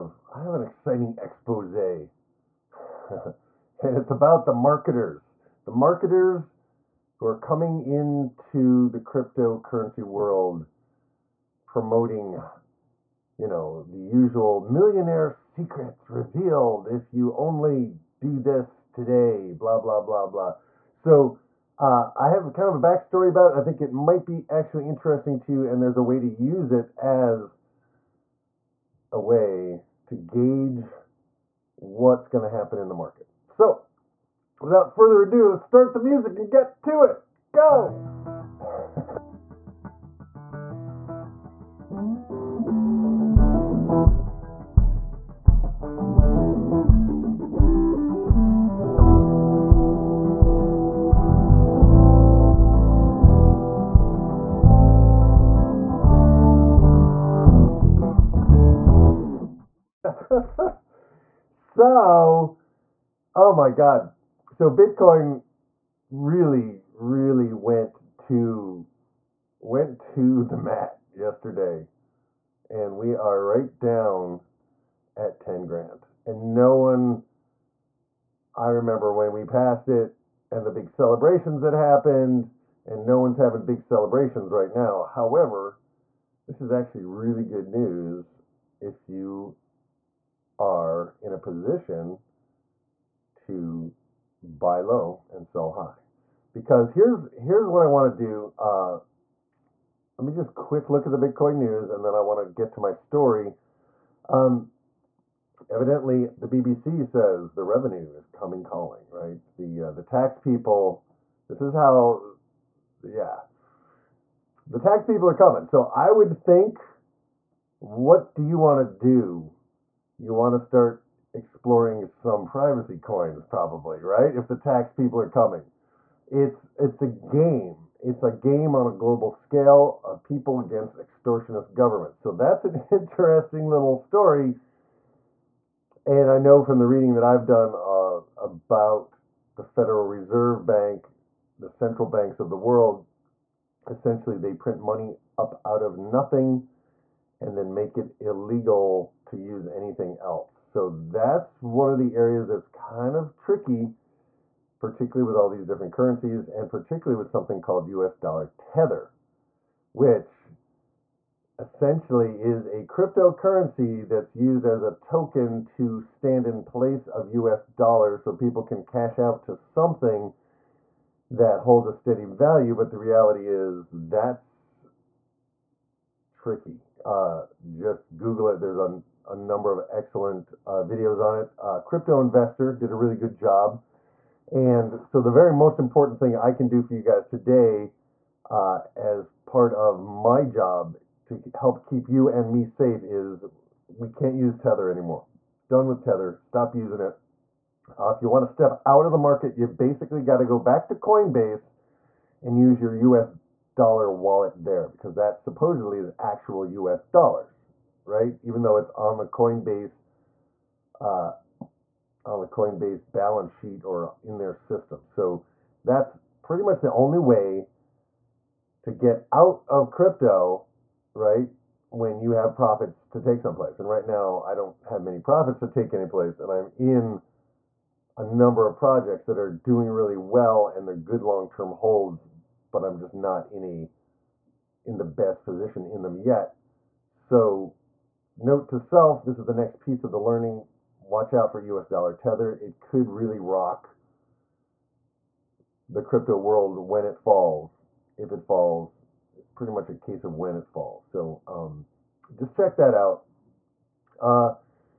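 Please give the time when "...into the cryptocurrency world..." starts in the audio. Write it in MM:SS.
00:07.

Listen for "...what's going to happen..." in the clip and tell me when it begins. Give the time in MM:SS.
00:31.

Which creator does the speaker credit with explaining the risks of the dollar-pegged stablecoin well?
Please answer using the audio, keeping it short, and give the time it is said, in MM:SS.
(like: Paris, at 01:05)
Crypto Investor, at 03:01.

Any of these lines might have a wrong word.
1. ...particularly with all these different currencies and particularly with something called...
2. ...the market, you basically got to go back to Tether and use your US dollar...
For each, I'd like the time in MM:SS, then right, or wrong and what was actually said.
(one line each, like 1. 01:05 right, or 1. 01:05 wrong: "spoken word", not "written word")
1. 02:34 right
2. 03:19 wrong: "Coinbase", not "Tether".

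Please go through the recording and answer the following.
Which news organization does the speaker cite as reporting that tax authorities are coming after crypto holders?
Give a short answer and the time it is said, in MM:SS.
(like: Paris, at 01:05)
BBC, at 01:46.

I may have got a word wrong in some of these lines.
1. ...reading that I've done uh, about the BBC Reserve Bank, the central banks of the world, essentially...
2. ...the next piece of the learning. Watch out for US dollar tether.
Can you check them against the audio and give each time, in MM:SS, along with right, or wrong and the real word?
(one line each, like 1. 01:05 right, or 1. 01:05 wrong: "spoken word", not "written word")
1. 02:16 wrong: "Federal", not "BBC"
2. 03:59 right.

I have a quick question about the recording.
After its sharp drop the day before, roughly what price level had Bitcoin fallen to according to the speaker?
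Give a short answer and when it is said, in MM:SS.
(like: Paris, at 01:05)
$10,000, at 01:15.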